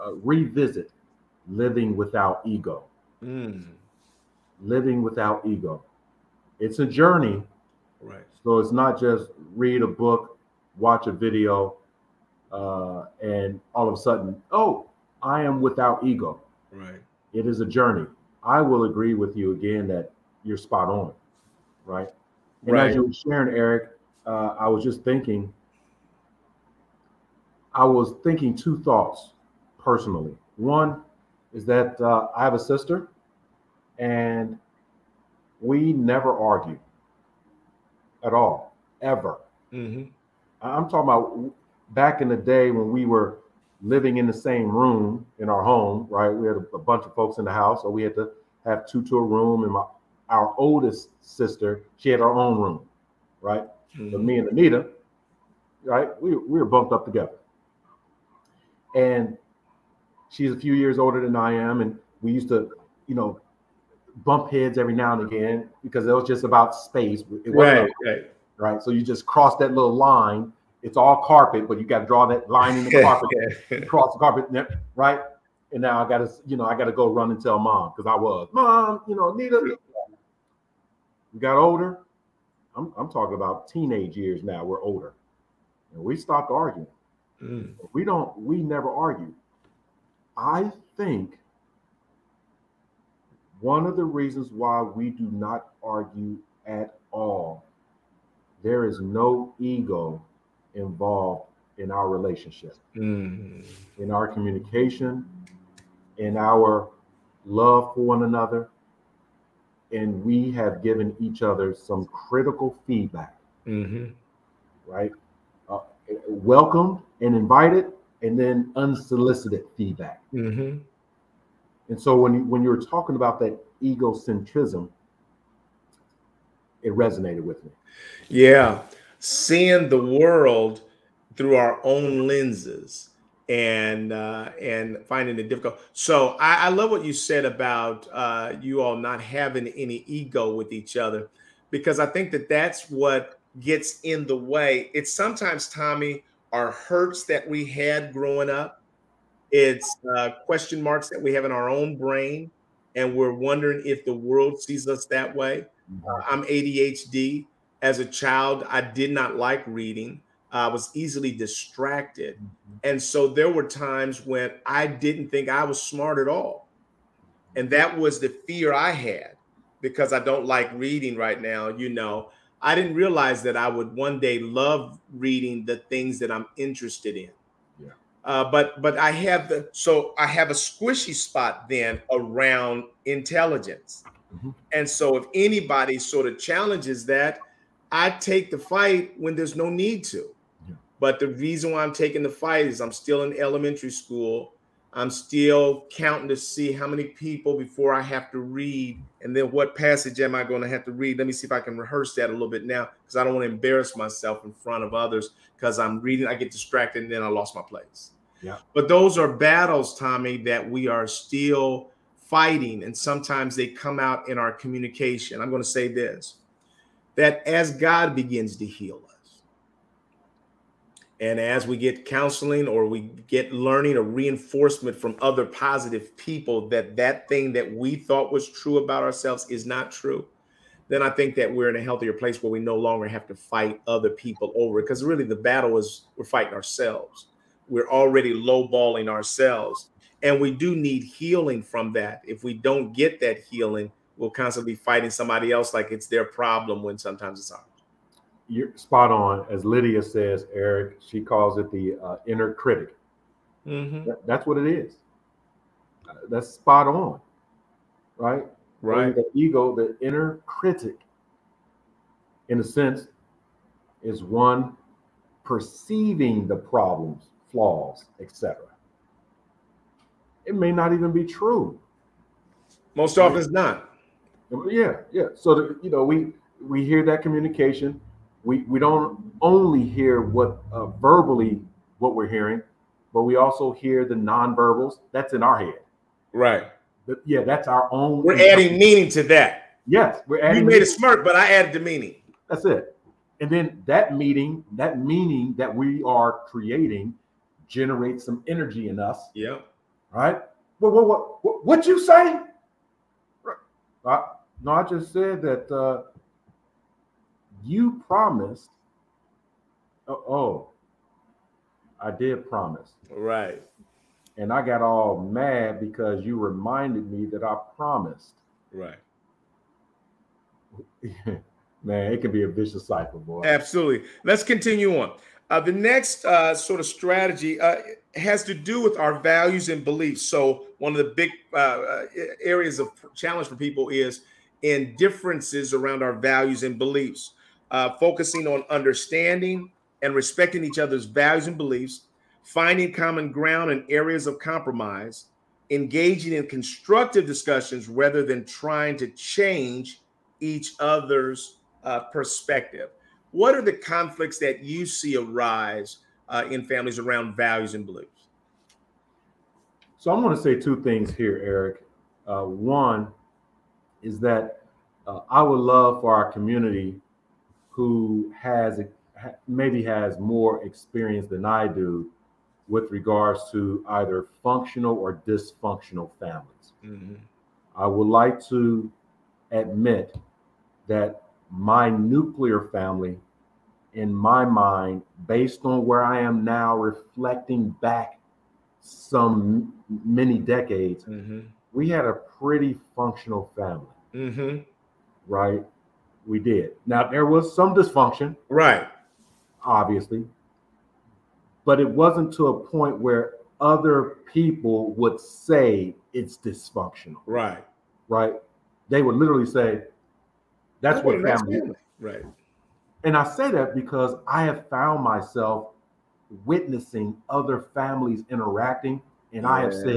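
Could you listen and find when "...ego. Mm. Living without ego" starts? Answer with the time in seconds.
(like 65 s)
2 s.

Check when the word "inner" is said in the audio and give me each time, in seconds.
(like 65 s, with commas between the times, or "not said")
252 s, 260 s.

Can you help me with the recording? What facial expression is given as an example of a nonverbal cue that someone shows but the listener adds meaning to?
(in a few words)
A smirk.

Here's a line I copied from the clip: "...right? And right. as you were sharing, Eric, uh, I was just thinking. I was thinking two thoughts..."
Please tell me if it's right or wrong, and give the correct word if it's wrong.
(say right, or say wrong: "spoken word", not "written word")
right.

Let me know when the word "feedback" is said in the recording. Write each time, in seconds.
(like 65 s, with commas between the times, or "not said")
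112 s, 119 s.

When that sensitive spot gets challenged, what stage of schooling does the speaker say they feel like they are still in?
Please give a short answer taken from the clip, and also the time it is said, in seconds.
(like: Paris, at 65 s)
Elementary school, at 193 s.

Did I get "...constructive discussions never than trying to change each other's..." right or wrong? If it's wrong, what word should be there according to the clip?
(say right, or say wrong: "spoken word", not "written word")
wrong: "rather", not "never".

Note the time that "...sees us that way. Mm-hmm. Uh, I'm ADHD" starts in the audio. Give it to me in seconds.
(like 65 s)
154 s.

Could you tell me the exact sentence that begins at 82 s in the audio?
I'm, I'm talking about teenage years now.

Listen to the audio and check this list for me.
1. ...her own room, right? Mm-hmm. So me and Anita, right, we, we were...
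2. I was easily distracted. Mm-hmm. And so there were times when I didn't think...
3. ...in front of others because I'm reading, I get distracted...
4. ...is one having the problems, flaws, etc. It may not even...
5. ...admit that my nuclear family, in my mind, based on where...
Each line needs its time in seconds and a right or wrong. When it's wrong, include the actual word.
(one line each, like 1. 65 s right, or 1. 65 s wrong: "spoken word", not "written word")
1. 52 s right
2. 160 s right
3. 204 s right
4. 264 s wrong: "perceiving", not "having"
5. 379 s right.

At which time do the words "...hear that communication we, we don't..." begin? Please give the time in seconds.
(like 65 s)
276 s.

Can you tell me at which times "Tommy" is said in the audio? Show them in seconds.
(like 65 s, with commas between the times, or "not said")
145 s, 209 s.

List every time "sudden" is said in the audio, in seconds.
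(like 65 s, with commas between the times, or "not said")
13 s.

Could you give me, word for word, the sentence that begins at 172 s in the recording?
I didn't realize that I would one day love reading the things that I'm interested in.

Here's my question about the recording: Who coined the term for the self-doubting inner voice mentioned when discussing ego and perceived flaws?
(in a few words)
Lydia.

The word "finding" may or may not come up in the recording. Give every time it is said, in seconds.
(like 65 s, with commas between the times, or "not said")
135 s, 342 s.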